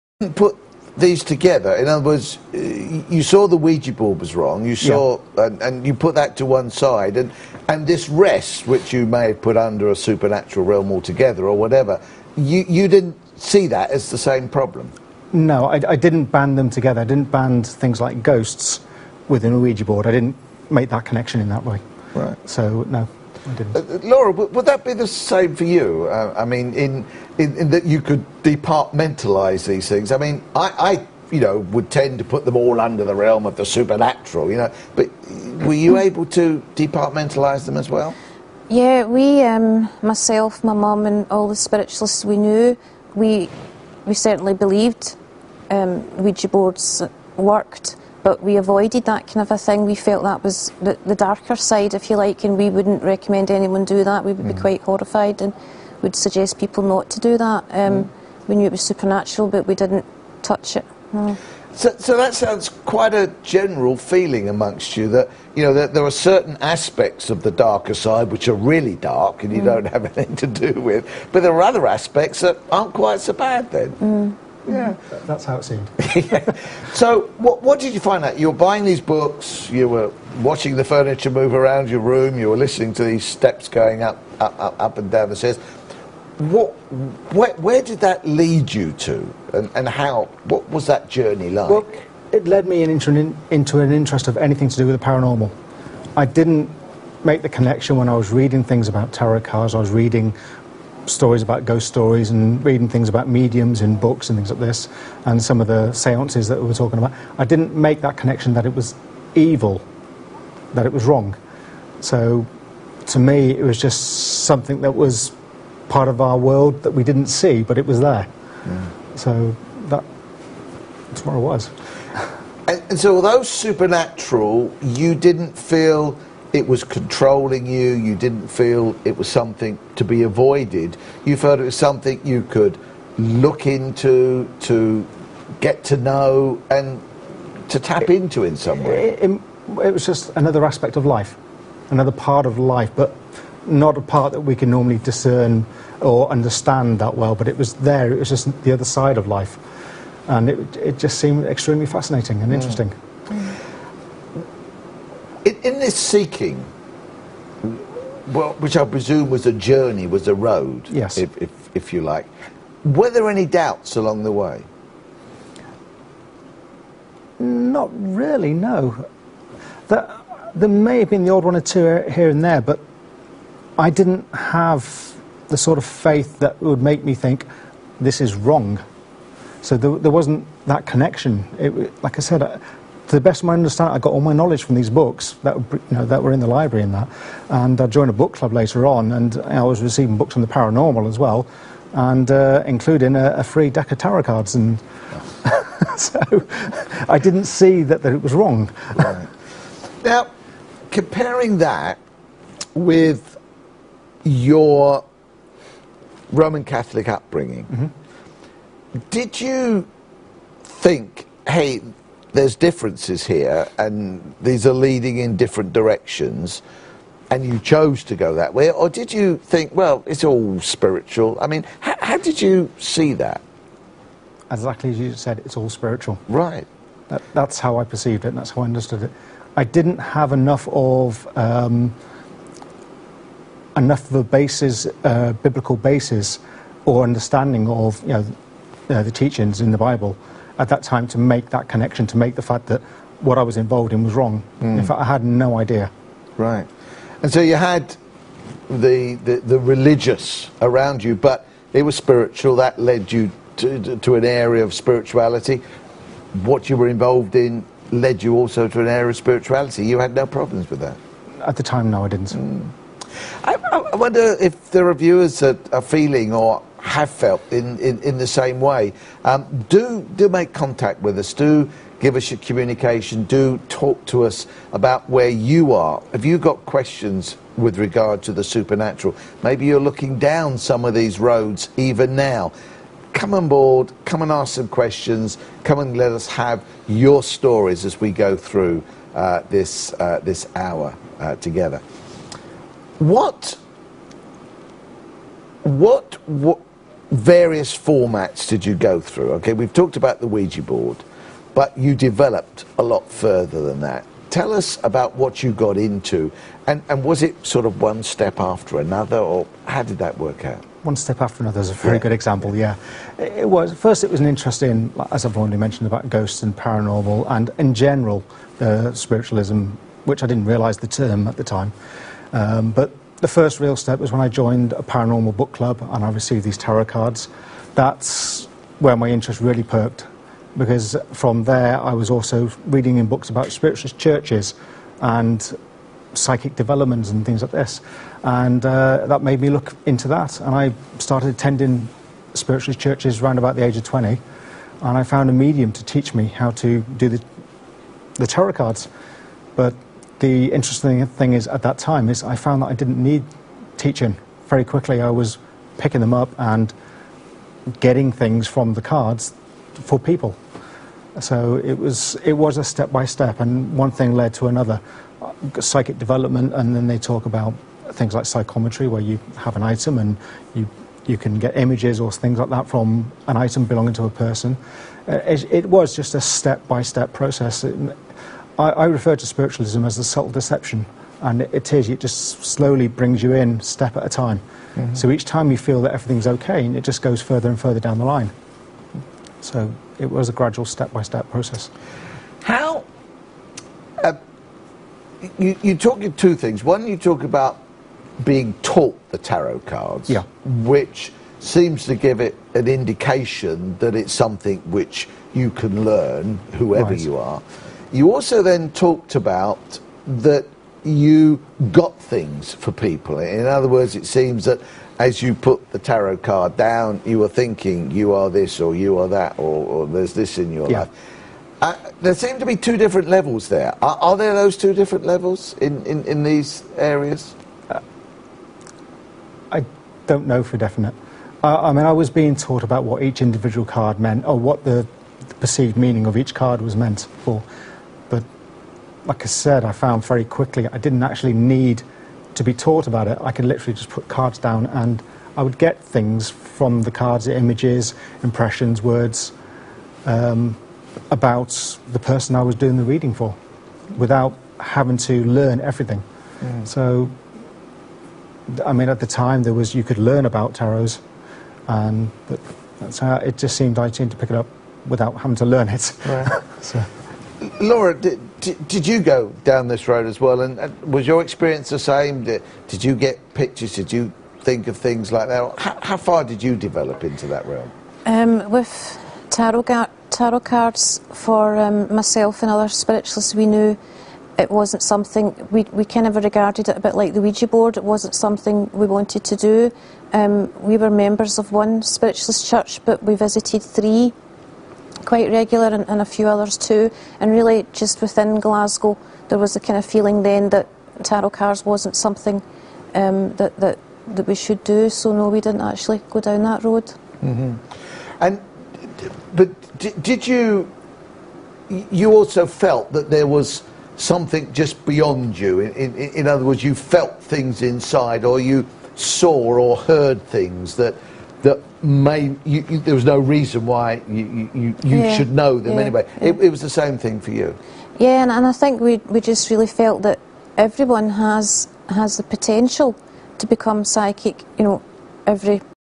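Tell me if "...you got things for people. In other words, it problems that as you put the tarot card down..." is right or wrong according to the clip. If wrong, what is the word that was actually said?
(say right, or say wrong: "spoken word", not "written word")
wrong: "seems", not "problems".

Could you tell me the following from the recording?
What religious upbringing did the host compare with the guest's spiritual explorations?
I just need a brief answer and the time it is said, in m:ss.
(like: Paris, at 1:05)
Roman Catholic, at 3:26.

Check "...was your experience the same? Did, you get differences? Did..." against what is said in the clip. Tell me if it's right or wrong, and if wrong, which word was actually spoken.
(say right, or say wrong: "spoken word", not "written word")
wrong: "pictures", not "differences".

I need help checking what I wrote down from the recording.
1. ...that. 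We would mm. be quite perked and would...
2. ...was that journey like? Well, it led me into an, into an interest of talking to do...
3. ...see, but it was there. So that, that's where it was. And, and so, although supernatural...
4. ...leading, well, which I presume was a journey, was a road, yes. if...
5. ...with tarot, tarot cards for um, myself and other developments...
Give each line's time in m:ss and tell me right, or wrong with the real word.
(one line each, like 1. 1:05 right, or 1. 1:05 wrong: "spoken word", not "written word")
1. 0:54 wrong: "horrified", not "perked"
2. 1:30 wrong: "anything", not "talking"
3. 1:57 right
4. 2:35 wrong: "seeking", not "leading"
5. 7:58 wrong: "spiritualists", not "developments".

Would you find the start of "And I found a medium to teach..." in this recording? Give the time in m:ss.
5:44.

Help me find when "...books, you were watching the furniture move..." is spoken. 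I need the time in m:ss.
1:19.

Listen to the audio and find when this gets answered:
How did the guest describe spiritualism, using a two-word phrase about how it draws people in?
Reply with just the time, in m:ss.
6:20.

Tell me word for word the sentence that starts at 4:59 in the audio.
Okay, we've talked about the Ouija board, but you developed a lot further than that.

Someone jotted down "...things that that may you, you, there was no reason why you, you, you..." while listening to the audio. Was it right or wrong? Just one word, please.
right.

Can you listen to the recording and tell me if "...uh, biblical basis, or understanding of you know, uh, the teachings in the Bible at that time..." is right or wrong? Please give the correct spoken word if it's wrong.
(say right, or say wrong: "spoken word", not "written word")
right.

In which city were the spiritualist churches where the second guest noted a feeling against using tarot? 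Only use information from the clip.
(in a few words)
Glasgow.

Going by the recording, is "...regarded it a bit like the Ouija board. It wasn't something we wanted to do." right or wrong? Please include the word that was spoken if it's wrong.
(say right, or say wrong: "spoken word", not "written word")
right.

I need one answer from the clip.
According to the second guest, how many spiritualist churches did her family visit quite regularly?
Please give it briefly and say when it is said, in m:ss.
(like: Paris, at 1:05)
3, at 8:13.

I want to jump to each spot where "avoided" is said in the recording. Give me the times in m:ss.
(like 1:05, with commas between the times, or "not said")
0:48, 2:10.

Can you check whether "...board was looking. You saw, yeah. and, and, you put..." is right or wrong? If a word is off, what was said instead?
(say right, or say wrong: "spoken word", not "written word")
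wrong: "wrong", not "looking".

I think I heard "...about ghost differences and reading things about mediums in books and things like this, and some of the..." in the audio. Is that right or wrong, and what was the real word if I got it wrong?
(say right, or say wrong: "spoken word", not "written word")
wrong: "stories", not "differences".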